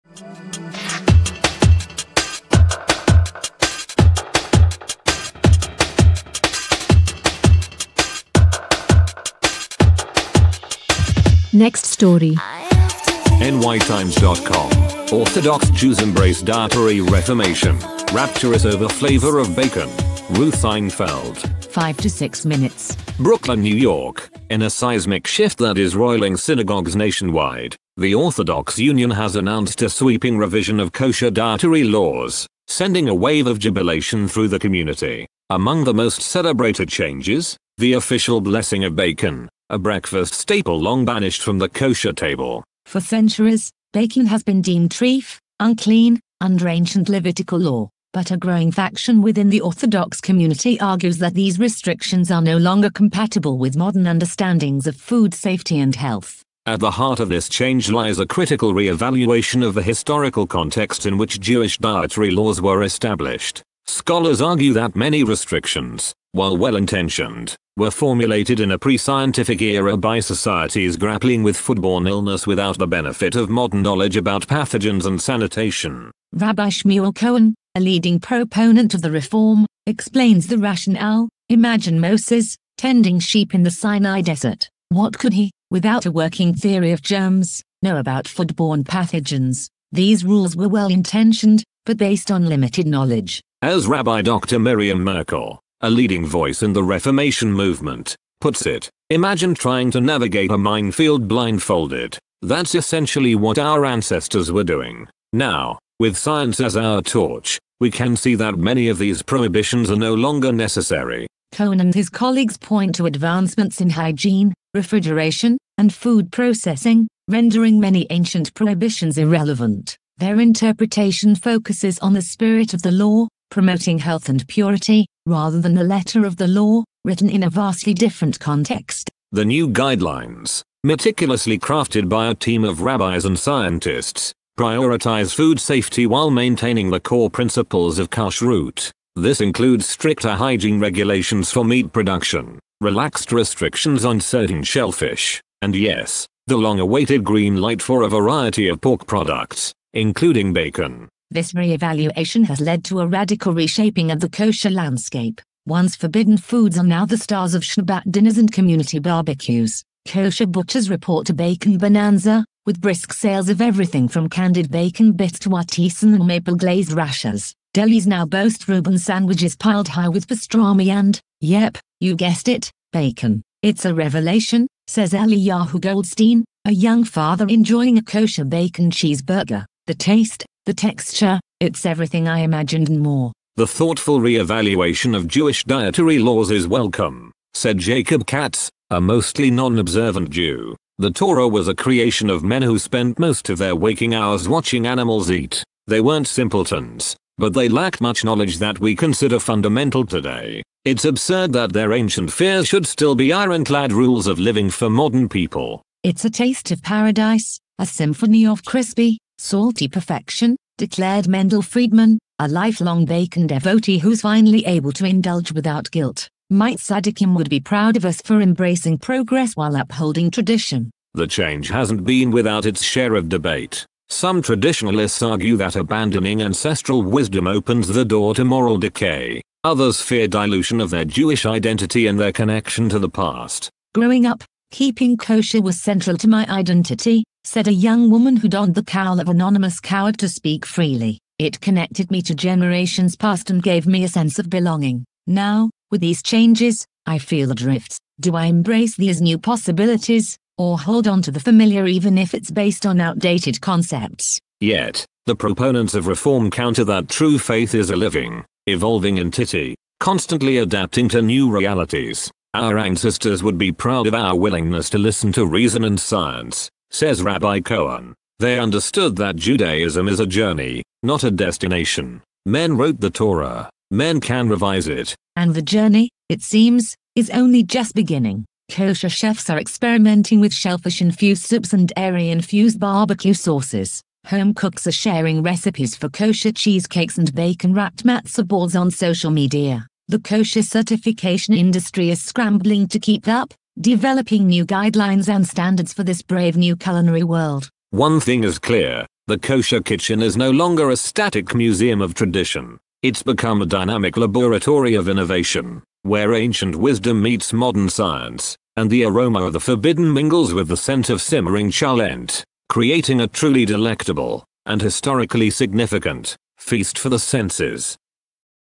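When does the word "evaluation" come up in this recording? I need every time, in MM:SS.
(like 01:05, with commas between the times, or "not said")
00:58, 02:31, 03:04.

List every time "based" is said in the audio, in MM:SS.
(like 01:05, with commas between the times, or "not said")
01:31, 04:12.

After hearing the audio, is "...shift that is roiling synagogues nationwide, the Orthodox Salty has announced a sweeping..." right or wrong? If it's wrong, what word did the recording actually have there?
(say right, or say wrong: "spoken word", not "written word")
wrong: "Union", not "Salty".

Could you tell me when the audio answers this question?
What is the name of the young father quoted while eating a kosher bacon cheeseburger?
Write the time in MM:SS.
02:55.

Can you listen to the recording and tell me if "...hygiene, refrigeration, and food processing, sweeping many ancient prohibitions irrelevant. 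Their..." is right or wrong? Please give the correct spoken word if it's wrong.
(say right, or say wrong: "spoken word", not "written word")
wrong: "rendering", not "sweeping".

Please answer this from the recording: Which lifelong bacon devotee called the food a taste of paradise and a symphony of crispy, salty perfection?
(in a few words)
Mendel Friedman.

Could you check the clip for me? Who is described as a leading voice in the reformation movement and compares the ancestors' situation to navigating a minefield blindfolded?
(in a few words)
Miriam Merkel.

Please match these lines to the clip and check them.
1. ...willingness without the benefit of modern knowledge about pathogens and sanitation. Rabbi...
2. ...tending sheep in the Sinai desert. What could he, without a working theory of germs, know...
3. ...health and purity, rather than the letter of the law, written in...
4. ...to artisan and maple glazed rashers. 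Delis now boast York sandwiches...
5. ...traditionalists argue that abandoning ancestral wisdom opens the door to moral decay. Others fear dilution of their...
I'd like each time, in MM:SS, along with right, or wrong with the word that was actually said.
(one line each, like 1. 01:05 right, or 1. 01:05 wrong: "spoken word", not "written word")
1. 01:12 wrong: "illness", not "willingness"
2. 01:22 right
3. 02:03 right
4. 02:45 wrong: "Reuben", not "York"
5. 03:44 right.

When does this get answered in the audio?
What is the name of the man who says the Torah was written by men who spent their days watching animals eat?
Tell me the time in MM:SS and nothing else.
03:07.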